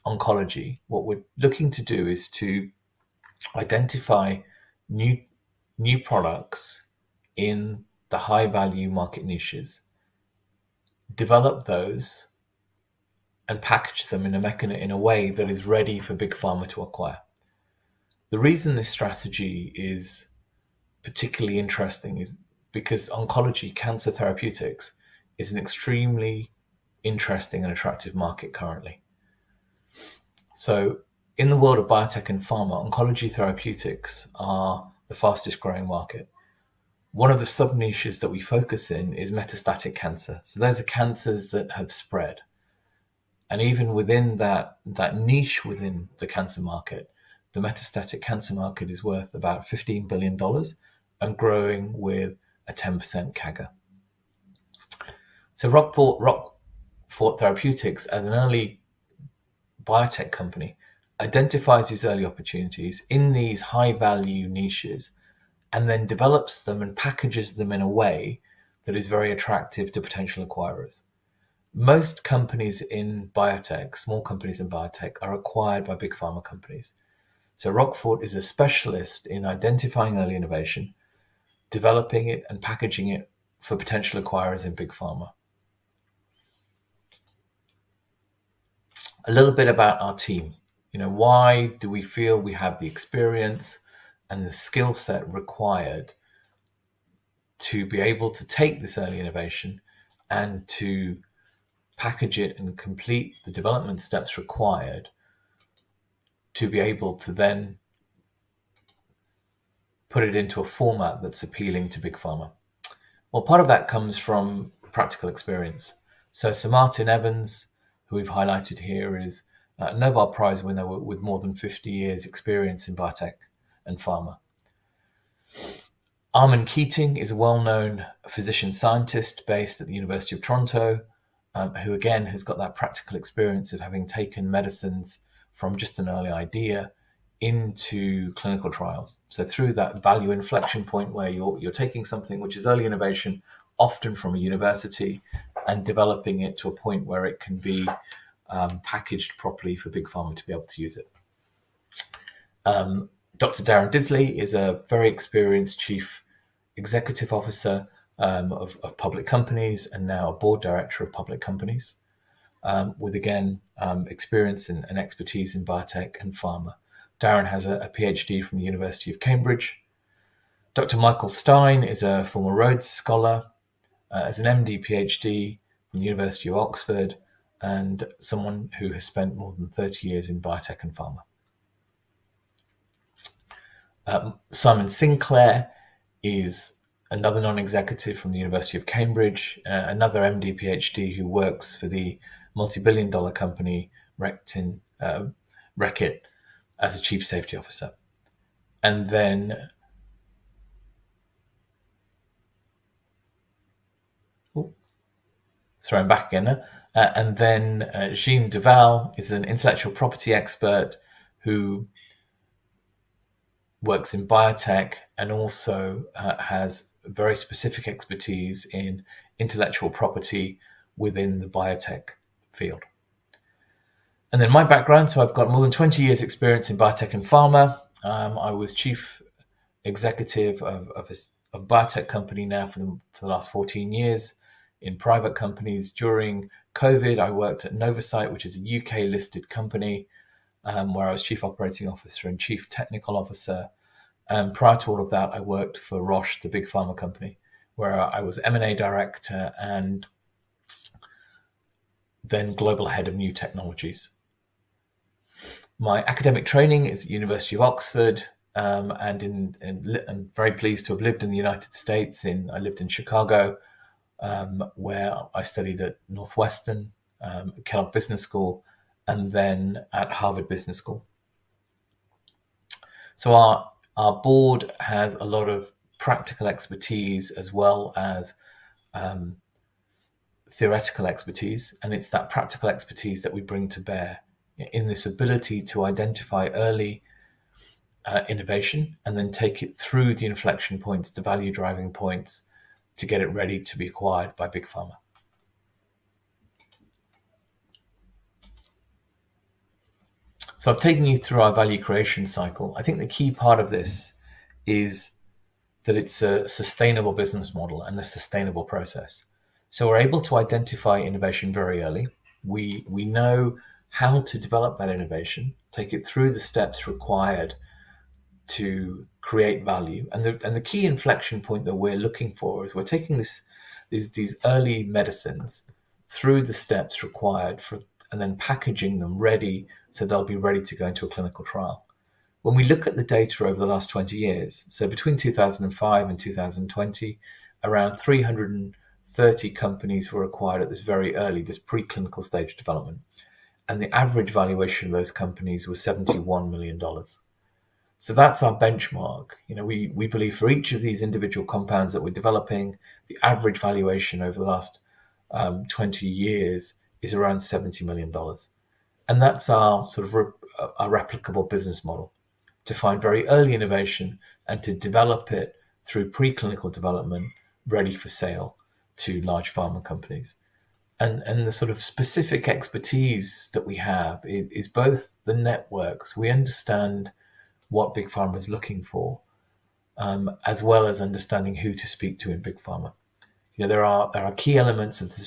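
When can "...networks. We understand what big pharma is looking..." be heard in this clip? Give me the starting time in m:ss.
6:15.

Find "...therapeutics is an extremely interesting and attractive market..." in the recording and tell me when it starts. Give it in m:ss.
0:24.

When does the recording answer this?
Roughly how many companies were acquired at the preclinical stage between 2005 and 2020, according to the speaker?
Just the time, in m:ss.
5:37.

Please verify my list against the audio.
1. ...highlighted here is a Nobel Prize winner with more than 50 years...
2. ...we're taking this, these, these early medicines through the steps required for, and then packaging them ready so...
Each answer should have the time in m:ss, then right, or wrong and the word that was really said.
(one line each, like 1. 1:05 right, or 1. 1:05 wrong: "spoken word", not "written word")
1. 1:58 right
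2. 5:22 right.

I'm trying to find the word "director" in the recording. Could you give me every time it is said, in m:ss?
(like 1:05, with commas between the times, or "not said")
2:40, 4:08.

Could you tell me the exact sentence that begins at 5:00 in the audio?
So I've taken you through our value creation cycle.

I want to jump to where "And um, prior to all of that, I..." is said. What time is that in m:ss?
4:04.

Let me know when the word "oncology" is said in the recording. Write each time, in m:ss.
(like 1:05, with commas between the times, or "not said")
0:00, 0:23, 0:32.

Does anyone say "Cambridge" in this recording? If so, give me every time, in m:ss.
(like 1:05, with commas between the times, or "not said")
2:49, 3:08.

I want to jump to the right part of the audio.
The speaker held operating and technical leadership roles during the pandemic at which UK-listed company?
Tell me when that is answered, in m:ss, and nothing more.
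3:57.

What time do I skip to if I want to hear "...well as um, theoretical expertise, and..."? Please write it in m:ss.
4:37.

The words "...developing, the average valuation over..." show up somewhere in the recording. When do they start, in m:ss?
5:52.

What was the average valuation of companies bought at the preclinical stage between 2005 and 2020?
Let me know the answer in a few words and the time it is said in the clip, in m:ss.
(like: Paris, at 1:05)
$71 million, at 5:45.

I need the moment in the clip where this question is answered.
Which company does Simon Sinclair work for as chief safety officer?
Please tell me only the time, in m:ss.
3:15.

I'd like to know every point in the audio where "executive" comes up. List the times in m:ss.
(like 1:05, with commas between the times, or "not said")
2:36, 3:07, 3:49.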